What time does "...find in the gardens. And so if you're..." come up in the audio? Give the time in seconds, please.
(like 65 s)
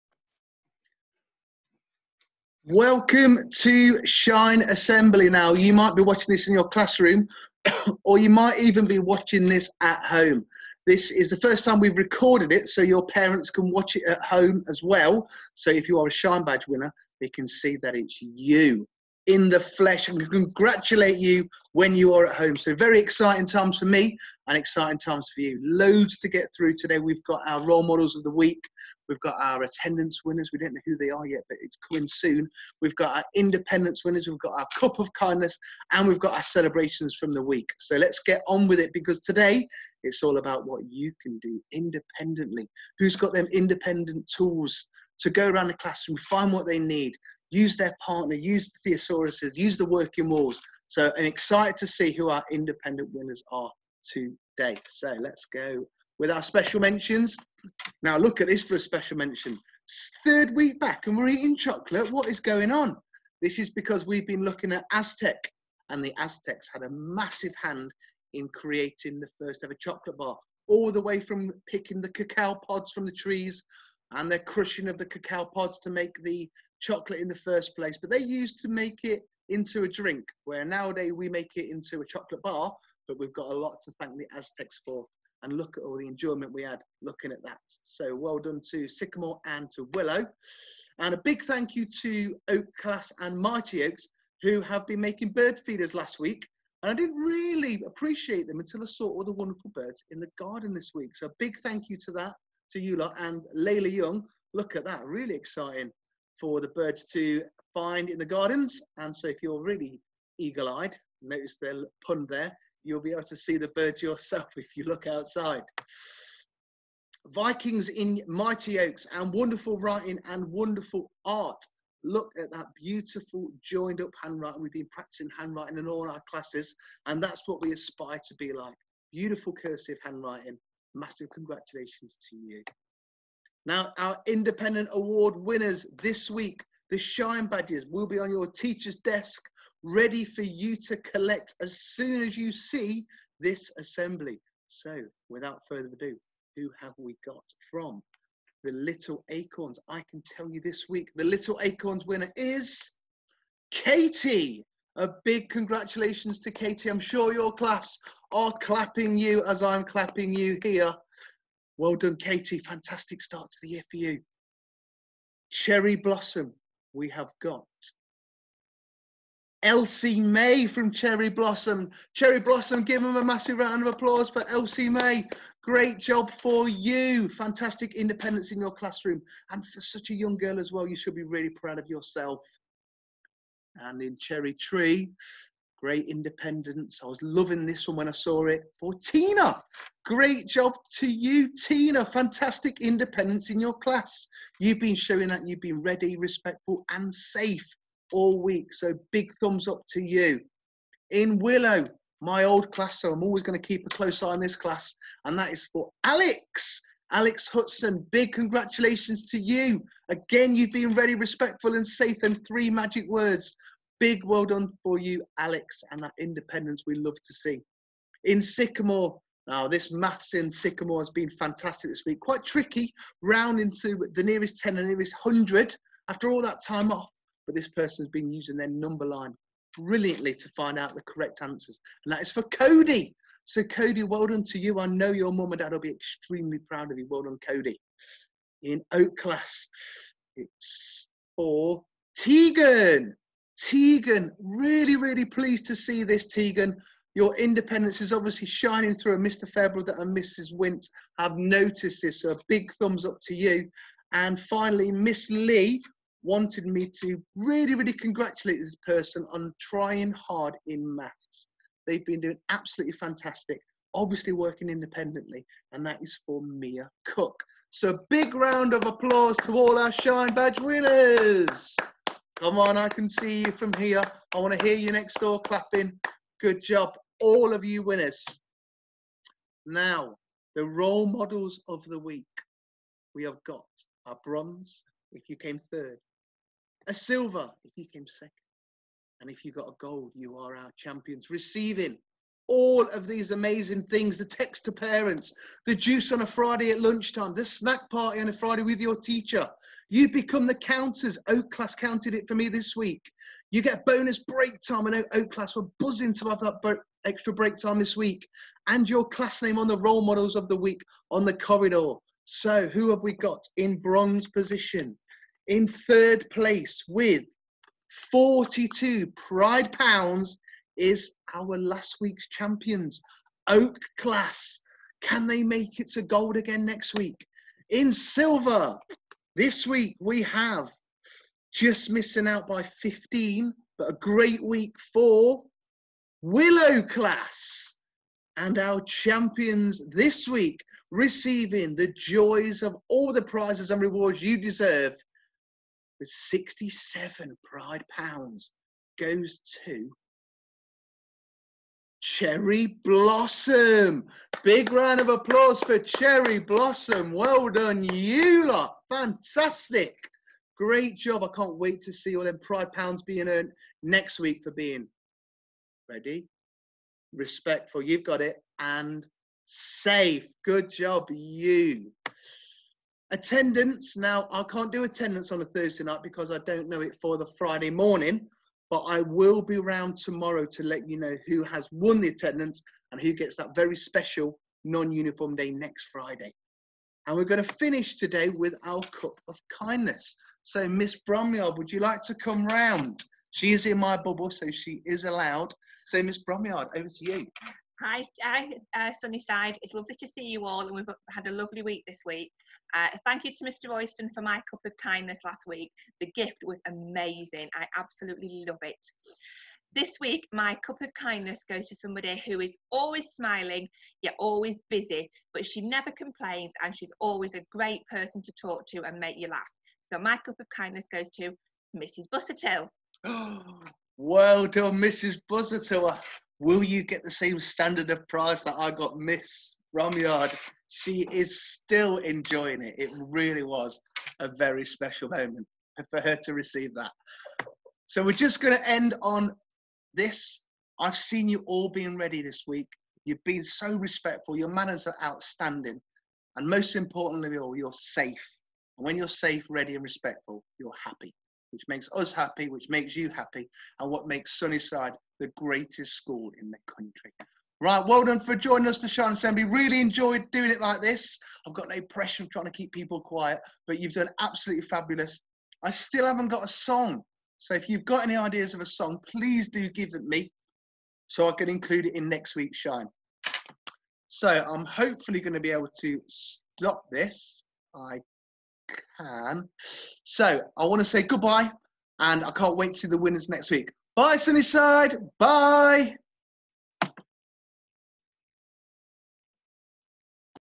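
107 s.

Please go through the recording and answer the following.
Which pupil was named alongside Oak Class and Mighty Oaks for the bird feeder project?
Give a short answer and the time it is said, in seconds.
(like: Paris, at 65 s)
Layla Young, at 103 s.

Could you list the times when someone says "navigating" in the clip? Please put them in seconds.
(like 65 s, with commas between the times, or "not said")
not said.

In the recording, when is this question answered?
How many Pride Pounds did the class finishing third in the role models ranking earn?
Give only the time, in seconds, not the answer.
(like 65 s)
318 s.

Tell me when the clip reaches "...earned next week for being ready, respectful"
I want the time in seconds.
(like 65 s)
363 s.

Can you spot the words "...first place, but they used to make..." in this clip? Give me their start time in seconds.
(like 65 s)
77 s.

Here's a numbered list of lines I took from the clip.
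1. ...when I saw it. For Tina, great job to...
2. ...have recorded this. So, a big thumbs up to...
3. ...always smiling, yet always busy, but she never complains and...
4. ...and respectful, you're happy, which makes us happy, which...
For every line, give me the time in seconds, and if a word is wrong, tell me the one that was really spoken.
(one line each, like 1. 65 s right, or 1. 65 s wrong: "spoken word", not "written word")
1. 187 s right
2. 251 s wrong: "noticed", not "recorded"
3. 412 s right
4. 449 s right.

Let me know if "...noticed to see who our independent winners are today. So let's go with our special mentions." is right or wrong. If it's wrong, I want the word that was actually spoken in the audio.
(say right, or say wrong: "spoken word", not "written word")
wrong: "excited", not "noticed".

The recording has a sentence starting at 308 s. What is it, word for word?
And your class name on the role models of the week on the corridor.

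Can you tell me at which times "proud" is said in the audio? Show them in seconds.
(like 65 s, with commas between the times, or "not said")
181 s, 236 s.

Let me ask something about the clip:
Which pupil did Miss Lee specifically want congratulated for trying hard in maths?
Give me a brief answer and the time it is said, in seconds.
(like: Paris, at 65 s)
Mia Cook, at 266 s.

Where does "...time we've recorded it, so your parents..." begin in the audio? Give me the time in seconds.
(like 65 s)
11 s.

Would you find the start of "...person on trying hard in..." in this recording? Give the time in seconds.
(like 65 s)
258 s.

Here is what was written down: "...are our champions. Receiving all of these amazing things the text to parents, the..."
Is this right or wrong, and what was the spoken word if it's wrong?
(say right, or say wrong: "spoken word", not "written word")
right.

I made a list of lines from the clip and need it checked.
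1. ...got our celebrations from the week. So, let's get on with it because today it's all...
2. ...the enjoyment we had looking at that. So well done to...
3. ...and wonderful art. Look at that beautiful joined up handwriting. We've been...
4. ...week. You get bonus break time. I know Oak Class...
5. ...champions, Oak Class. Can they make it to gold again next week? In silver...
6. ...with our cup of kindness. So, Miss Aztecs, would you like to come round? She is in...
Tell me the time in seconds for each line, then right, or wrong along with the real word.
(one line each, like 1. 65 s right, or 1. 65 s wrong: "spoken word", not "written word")
1. 36 s right
2. 85 s right
3. 120 s right
4. 302 s right
5. 322 s right
6. 388 s wrong: "Bromyard", not "Aztecs".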